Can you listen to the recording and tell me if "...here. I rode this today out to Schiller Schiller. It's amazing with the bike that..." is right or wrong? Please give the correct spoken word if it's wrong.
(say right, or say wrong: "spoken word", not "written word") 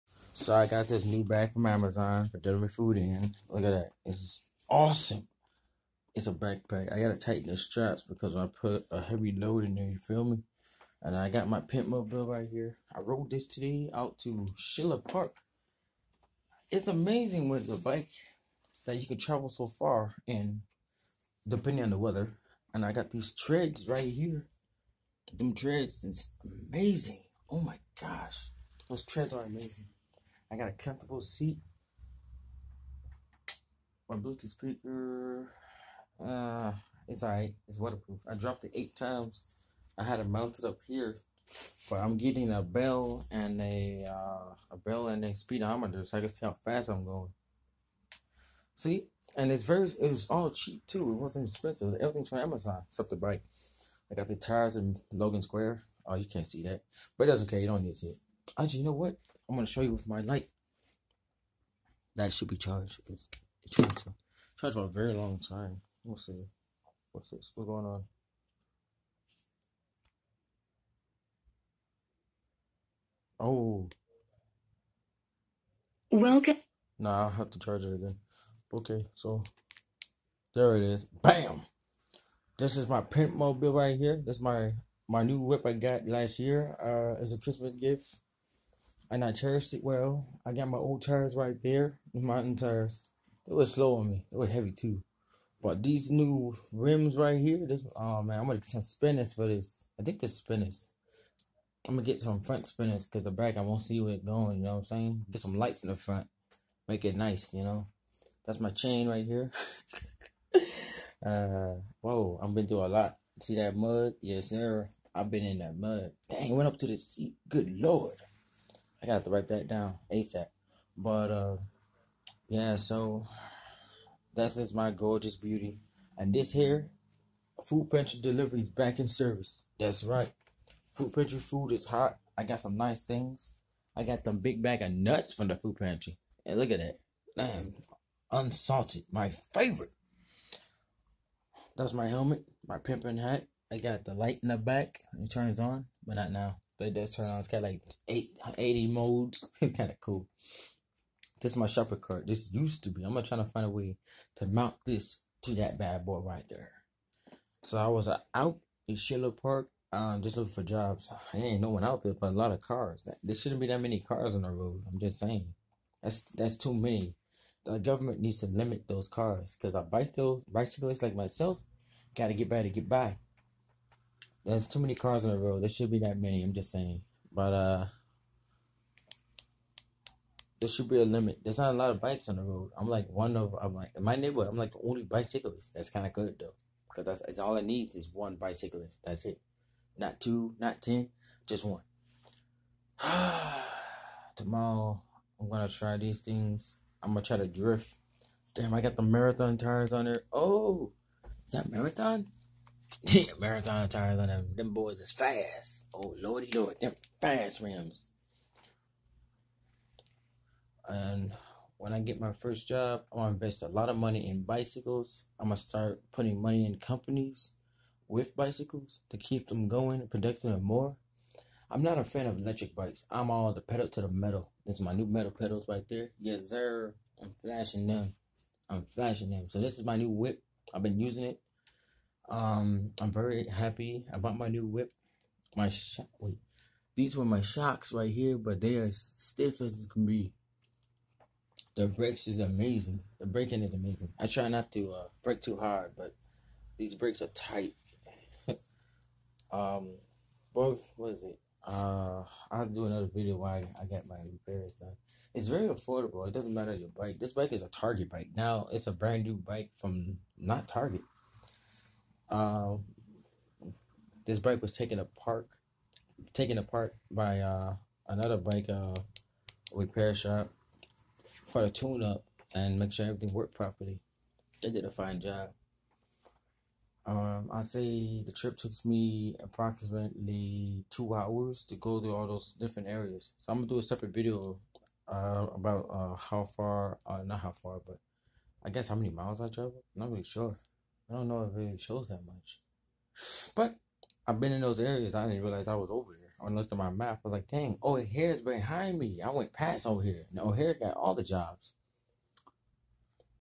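wrong: "Park", not "Schiller".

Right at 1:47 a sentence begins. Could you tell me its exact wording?
You know, that's my chain right here.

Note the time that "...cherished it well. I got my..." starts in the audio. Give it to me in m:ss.
1:29.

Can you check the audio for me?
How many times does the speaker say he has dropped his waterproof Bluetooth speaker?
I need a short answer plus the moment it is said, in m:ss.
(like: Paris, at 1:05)
8, at 0:38.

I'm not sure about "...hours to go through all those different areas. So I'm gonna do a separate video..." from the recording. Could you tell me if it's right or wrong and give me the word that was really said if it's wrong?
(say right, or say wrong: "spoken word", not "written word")
right.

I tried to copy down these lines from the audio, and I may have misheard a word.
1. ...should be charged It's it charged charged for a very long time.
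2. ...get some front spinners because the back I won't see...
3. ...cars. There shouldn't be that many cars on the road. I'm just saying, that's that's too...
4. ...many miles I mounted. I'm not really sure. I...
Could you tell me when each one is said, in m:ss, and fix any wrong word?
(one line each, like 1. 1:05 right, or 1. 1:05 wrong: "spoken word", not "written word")
1. 1:02 right
2. 1:42 right
3. 2:42 right
4. 4:48 wrong: "traveled", not "mounted".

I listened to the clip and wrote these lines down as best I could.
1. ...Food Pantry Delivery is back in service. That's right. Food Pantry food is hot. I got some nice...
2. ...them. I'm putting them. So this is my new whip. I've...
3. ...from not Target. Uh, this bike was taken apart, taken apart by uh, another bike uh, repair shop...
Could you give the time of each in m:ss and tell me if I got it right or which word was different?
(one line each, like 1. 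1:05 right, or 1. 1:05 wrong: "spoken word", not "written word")
1. 2:07 right
2. 3:47 wrong: "flashing", not "putting"
3. 4:19 right.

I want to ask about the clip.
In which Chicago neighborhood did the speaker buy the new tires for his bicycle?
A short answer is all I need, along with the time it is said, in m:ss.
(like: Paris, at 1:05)
Logan Square, at 0:55.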